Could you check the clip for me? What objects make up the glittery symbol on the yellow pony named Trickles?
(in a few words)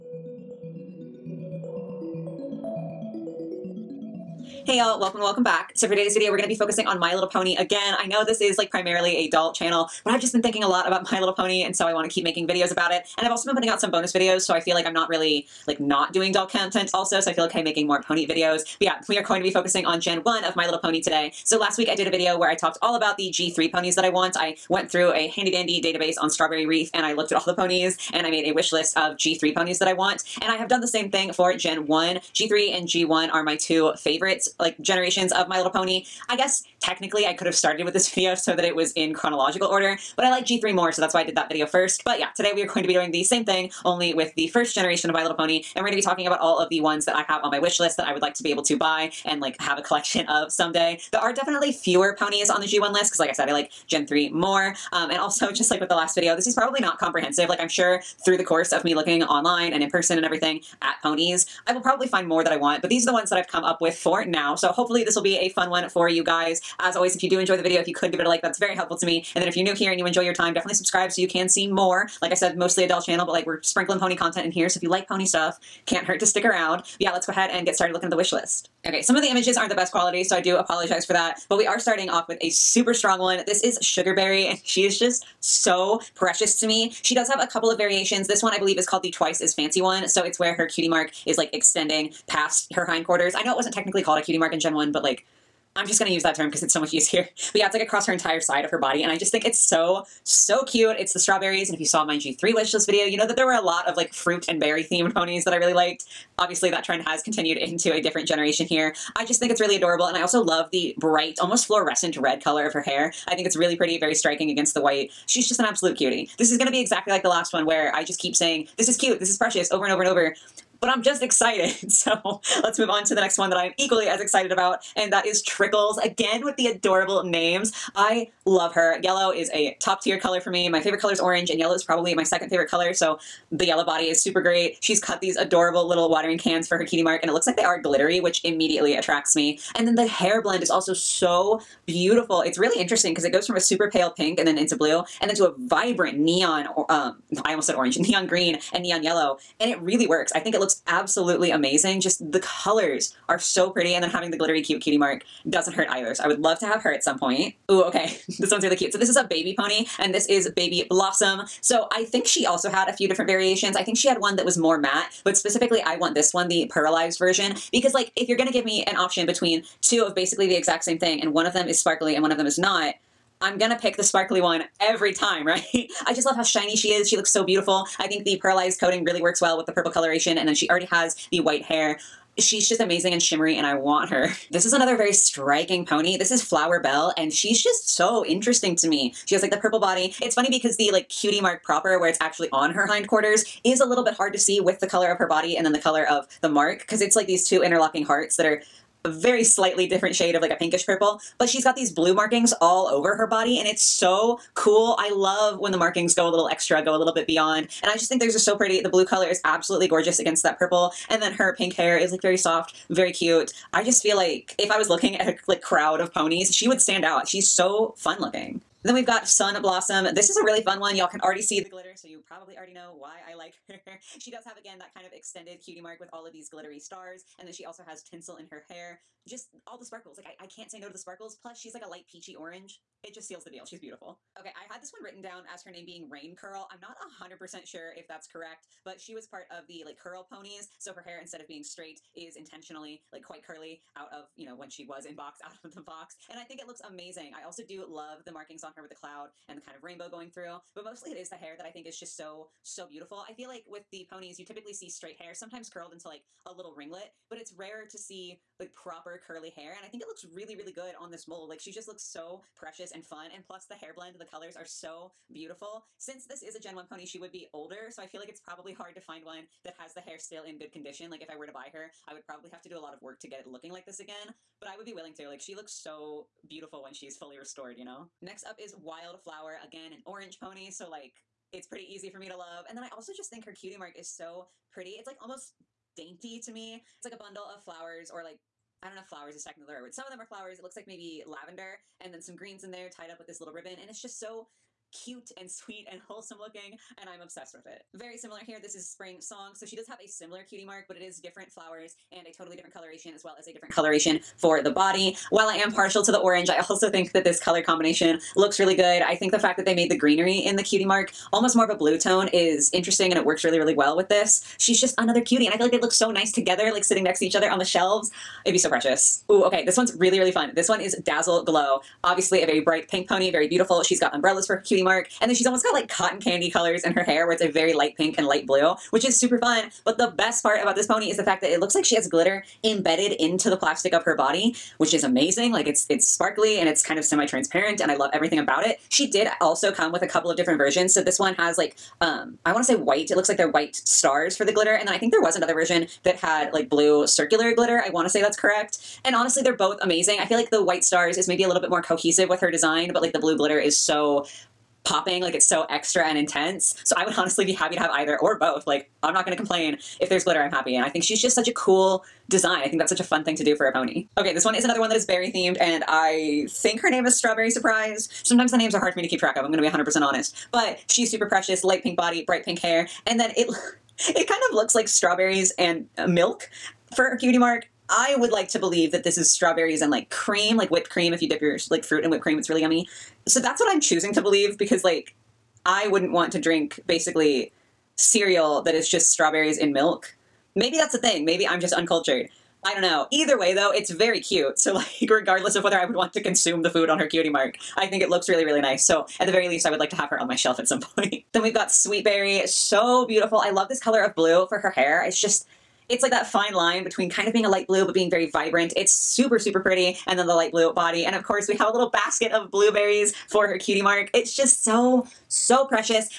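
Watering cans.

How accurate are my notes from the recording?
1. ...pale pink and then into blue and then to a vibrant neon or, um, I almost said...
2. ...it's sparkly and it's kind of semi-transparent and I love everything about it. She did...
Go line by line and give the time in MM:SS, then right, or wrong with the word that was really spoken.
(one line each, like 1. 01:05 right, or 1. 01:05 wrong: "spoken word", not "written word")
1. 02:23 right
2. 05:35 right.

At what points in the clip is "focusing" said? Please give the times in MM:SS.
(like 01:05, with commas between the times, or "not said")
00:06, 00:19.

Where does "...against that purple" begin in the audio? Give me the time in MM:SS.
03:30.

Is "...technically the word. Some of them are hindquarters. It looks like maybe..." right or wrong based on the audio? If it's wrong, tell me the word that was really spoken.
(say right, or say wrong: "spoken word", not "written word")
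wrong: "flowers", not "hindquarters".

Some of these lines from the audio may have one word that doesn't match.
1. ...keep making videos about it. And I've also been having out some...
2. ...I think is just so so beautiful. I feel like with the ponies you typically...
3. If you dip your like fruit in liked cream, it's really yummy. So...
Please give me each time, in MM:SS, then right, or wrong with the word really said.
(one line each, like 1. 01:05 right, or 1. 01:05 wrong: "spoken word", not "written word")
1. 00:12 wrong: "putting", not "having"
2. 04:11 right
3. 06:21 wrong: "whipped", not "liked".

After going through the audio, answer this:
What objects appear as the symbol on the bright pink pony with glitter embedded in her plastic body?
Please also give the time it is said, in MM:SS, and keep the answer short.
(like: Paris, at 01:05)
Umbrellas, at 05:24.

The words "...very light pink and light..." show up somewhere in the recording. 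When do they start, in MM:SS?
05:27.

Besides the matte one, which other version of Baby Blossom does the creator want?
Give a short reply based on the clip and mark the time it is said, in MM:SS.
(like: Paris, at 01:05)
The pearlized version, at 02:46.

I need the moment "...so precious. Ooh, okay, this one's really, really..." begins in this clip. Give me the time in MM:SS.
05:18.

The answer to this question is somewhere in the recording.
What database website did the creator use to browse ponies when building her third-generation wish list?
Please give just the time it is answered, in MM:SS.
00:26.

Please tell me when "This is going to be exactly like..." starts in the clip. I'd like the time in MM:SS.
01:56.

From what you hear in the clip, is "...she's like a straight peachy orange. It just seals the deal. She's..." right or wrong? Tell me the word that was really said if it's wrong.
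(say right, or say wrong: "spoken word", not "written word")
wrong: "light", not "straight".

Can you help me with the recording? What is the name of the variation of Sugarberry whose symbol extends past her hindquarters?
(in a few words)
Twice as fancy.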